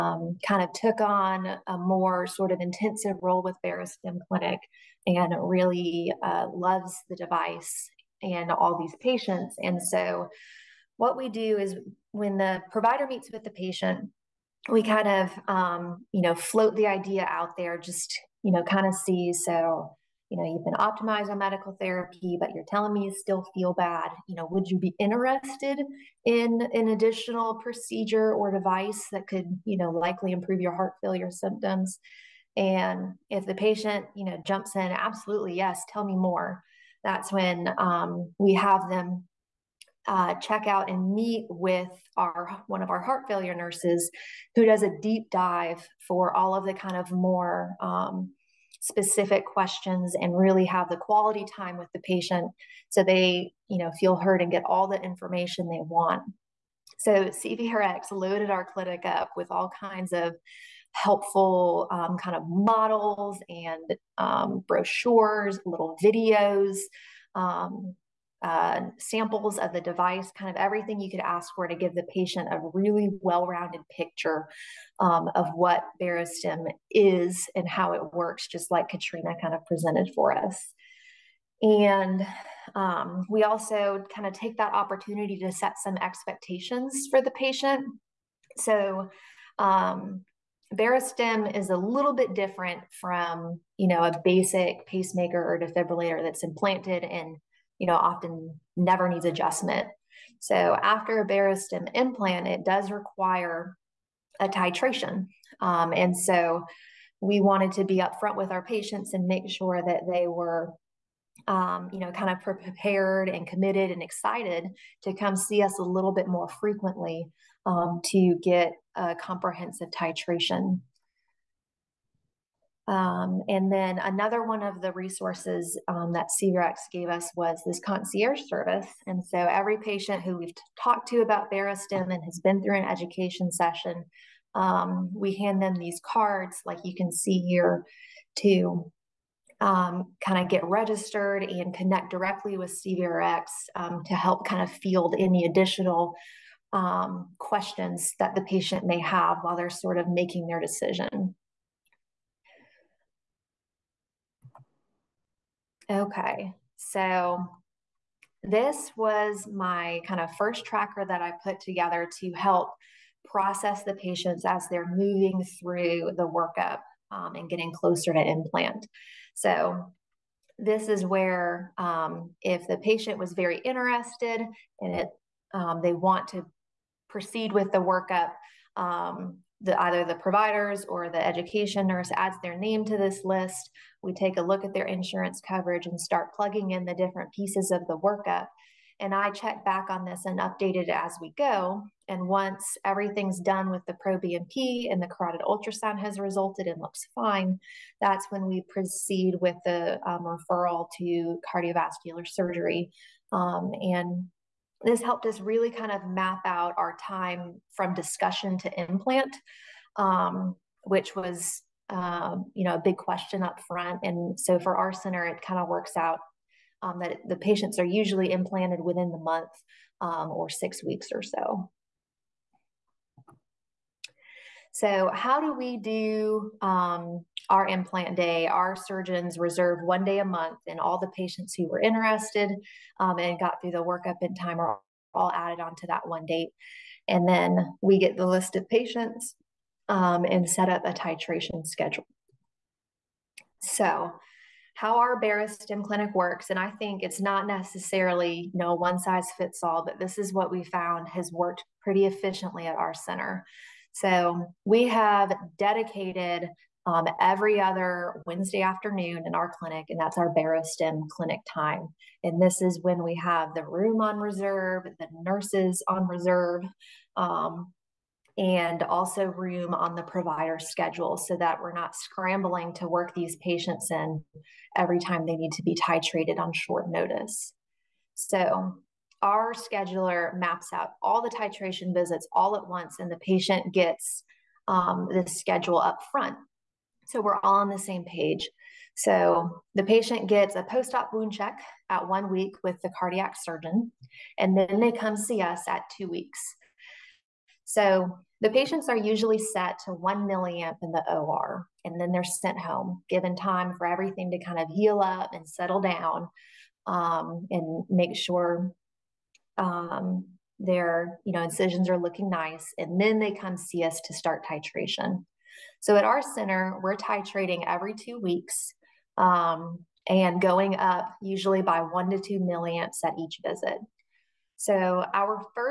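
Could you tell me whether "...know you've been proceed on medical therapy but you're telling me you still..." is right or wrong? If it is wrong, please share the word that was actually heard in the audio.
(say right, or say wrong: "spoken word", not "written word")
wrong: "optimized", not "proceed".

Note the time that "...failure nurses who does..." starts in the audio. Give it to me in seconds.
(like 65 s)
43 s.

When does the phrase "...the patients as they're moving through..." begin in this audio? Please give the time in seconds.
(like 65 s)
163 s.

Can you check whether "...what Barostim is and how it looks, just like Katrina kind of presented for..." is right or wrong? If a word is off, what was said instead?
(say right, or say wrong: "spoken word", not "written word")
wrong: "works", not "looks".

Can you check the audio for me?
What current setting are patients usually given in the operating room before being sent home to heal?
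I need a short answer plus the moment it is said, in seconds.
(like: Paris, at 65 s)
1 milliamp, at 299 s.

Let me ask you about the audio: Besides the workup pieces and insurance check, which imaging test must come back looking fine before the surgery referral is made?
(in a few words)
Carotid ultrasound.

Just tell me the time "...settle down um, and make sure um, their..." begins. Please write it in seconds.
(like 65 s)
305 s.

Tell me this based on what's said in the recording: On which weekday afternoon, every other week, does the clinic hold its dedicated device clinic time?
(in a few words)
Wednesday.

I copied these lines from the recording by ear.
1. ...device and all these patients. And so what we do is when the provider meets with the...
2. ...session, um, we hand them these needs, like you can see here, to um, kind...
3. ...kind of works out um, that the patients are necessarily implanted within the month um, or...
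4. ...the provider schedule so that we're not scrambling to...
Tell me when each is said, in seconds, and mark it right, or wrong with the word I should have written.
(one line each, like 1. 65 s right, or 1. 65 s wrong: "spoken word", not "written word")
1. 7 s right
2. 133 s wrong: "cards", not "needs"
3. 215 s wrong: "usually", not "necessarily"
4. 269 s right.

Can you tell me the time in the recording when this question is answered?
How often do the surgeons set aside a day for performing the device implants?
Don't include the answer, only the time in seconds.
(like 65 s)
229 s.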